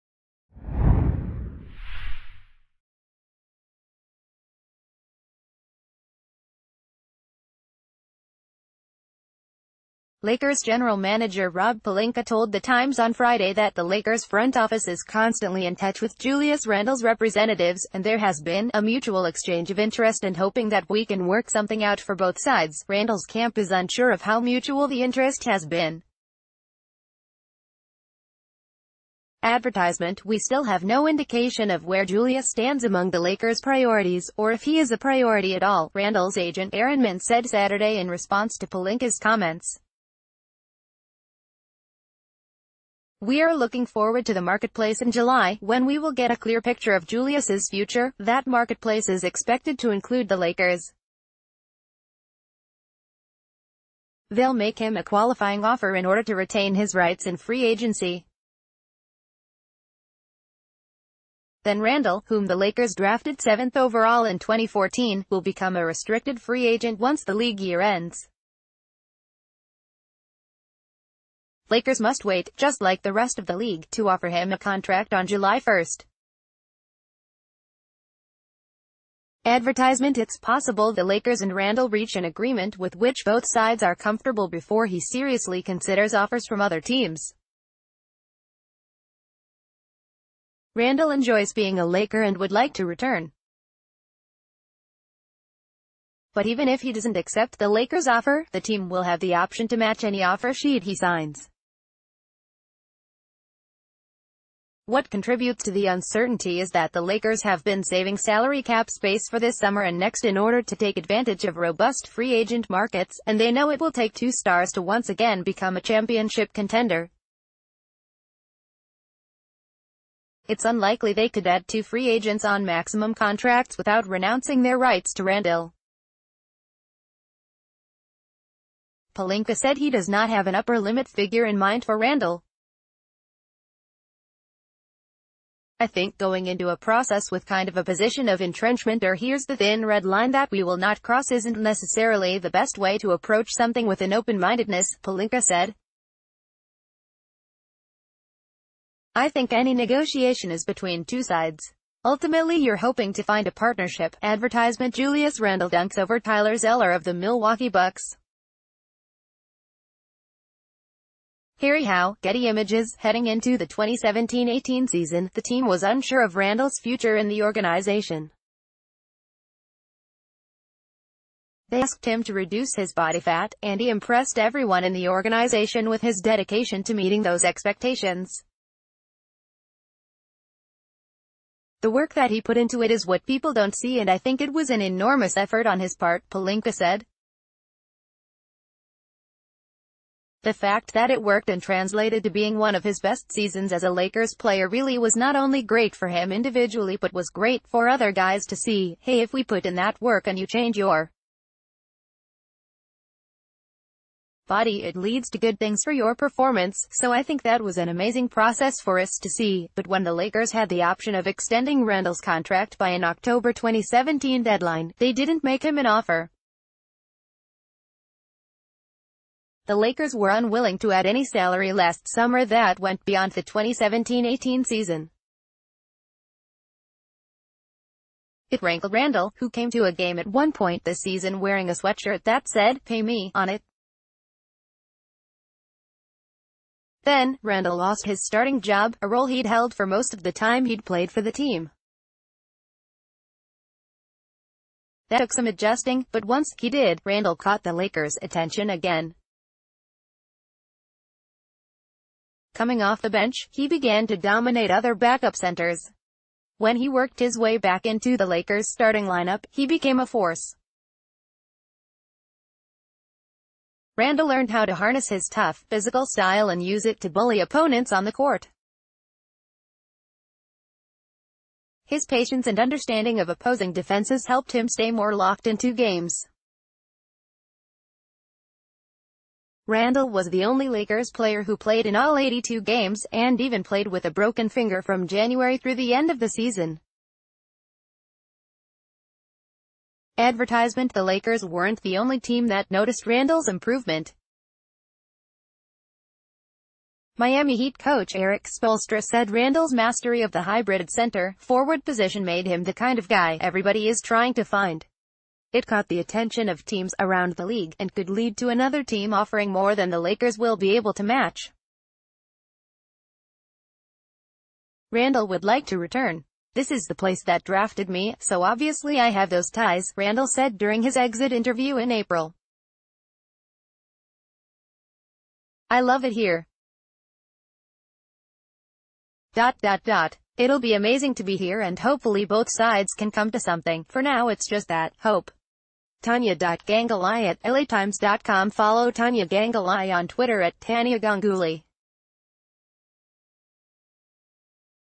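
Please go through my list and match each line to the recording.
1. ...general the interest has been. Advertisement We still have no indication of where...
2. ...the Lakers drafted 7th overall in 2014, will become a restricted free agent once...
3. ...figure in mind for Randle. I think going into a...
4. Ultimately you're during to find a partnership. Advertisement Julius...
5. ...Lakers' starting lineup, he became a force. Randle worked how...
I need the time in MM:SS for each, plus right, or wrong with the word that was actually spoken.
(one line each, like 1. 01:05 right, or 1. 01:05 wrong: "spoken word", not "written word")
1. 00:24 wrong: "mutual", not "general"
2. 01:02 right
3. 02:11 right
4. 02:32 wrong: "hoping", not "during"
5. 04:18 wrong: "learned", not "worked".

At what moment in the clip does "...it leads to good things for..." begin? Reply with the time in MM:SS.
03:24.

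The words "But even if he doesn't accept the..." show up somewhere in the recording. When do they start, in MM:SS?
01:36.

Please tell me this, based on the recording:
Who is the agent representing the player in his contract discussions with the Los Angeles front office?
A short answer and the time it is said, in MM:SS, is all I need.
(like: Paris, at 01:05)
Aaron Mintz, at 00:36.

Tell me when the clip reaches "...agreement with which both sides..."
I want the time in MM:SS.
01:22.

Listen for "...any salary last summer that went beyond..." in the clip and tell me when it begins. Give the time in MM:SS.
03:41.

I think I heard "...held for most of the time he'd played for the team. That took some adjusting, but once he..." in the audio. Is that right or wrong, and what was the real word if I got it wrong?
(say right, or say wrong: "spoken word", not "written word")
right.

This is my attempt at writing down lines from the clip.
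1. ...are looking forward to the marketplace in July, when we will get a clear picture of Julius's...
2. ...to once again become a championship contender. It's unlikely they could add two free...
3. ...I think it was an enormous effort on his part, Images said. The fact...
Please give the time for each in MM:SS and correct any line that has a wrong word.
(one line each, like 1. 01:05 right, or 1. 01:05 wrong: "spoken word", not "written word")
1. 00:43 right
2. 01:54 right
3. 03:04 wrong: "Pelinka", not "Images".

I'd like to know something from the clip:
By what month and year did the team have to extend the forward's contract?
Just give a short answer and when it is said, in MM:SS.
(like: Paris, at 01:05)
October 2017, at 03:33.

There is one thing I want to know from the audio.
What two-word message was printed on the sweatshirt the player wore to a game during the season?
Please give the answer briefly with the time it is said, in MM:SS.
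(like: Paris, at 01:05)
pay me, at 03:52.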